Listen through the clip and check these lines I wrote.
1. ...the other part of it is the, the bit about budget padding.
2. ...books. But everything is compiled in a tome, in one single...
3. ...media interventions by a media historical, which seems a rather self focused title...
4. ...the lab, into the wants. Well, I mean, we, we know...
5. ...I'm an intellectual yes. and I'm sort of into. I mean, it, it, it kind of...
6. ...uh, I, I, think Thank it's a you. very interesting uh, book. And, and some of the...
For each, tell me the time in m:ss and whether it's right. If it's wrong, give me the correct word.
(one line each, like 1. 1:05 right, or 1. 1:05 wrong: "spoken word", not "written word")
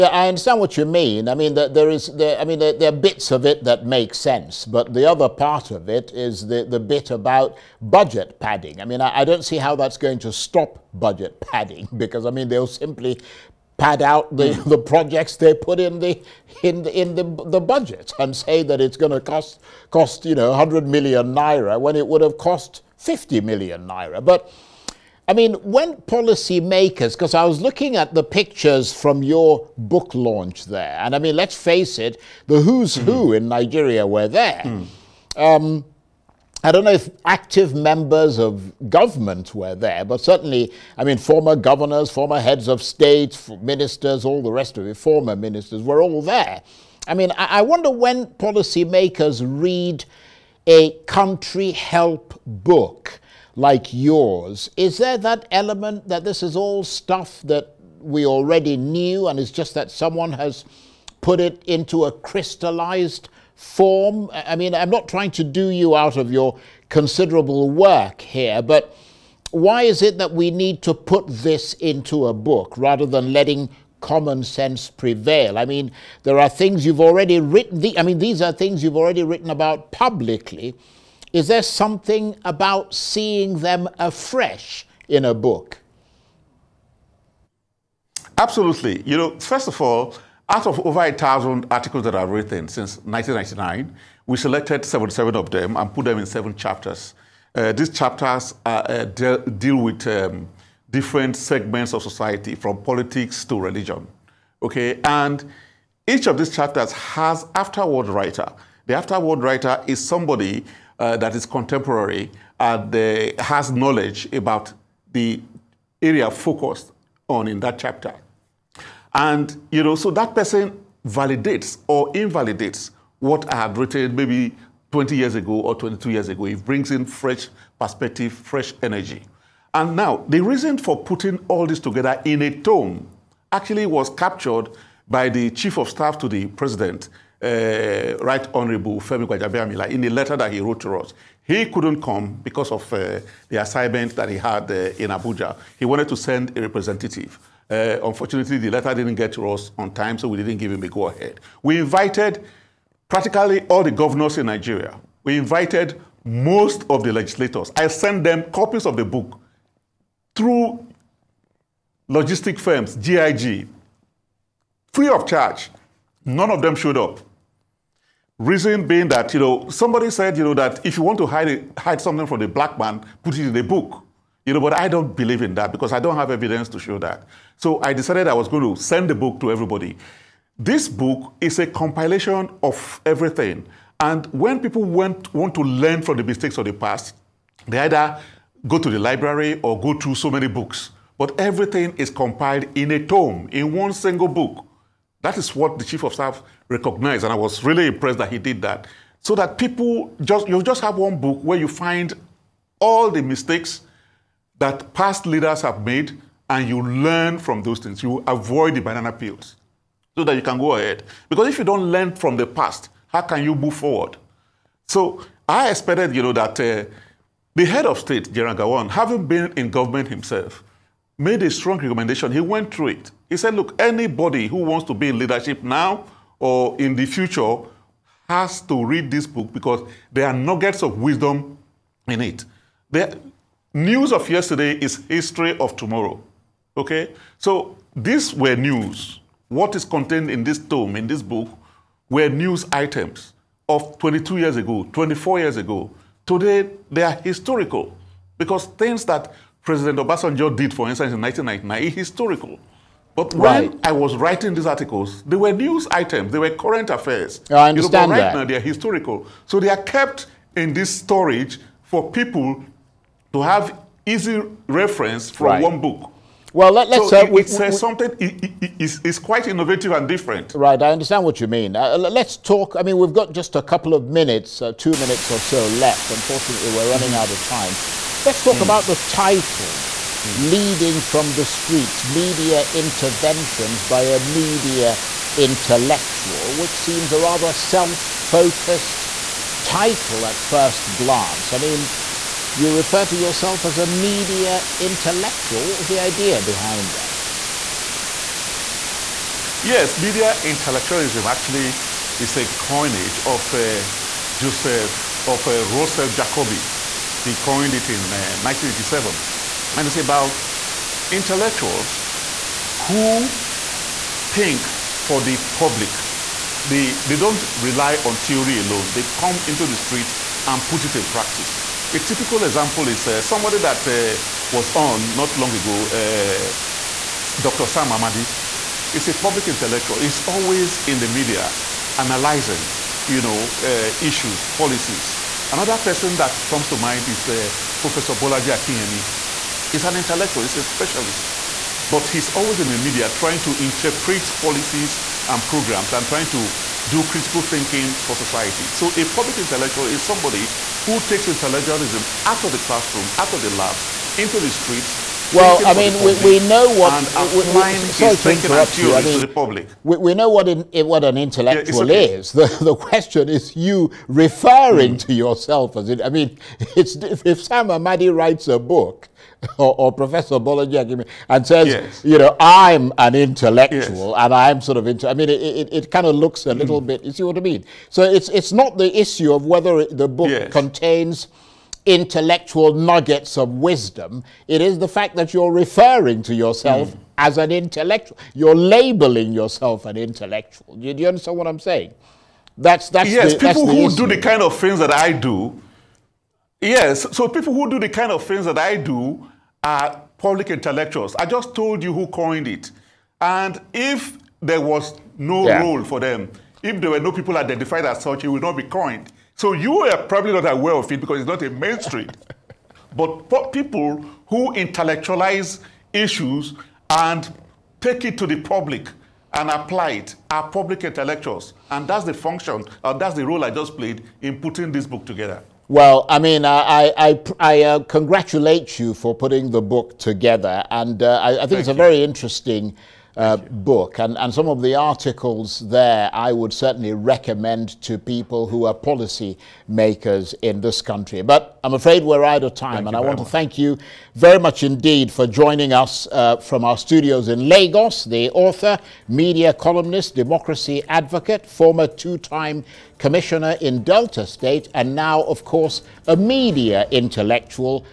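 1. 0:04 right
2. 3:10 right
3. 4:42 wrong: "intellectual", not "historical"
4. 5:53 wrong: "streets", not "wants"
5. 6:12 right
6. 7:11 right.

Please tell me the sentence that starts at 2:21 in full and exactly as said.
He couldn't come because of uh, the assignment that he had uh, in Abuja.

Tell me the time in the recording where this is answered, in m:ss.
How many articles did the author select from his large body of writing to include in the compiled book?
1:34.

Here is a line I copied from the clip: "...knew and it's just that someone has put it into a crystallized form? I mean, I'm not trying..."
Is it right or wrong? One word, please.
right.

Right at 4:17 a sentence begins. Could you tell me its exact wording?
I understand you know, but right that.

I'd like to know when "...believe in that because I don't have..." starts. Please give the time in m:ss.
2:55.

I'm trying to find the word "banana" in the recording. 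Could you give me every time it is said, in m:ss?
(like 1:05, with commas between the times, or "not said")
3:28.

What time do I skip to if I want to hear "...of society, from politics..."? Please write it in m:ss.
1:41.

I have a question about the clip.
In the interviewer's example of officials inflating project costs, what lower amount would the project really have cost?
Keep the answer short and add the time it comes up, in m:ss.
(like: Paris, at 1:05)
50 million naira, at 0:22.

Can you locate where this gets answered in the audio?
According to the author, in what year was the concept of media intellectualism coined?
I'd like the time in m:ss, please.
5:08.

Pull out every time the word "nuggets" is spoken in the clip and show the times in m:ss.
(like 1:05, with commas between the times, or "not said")
3:50, 6:22.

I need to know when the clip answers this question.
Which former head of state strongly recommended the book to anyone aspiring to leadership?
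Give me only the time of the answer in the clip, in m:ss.
3:38.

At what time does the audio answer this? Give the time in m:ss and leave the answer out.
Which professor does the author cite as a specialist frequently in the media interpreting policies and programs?
5:38.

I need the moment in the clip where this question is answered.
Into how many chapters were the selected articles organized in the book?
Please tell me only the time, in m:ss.
1:36.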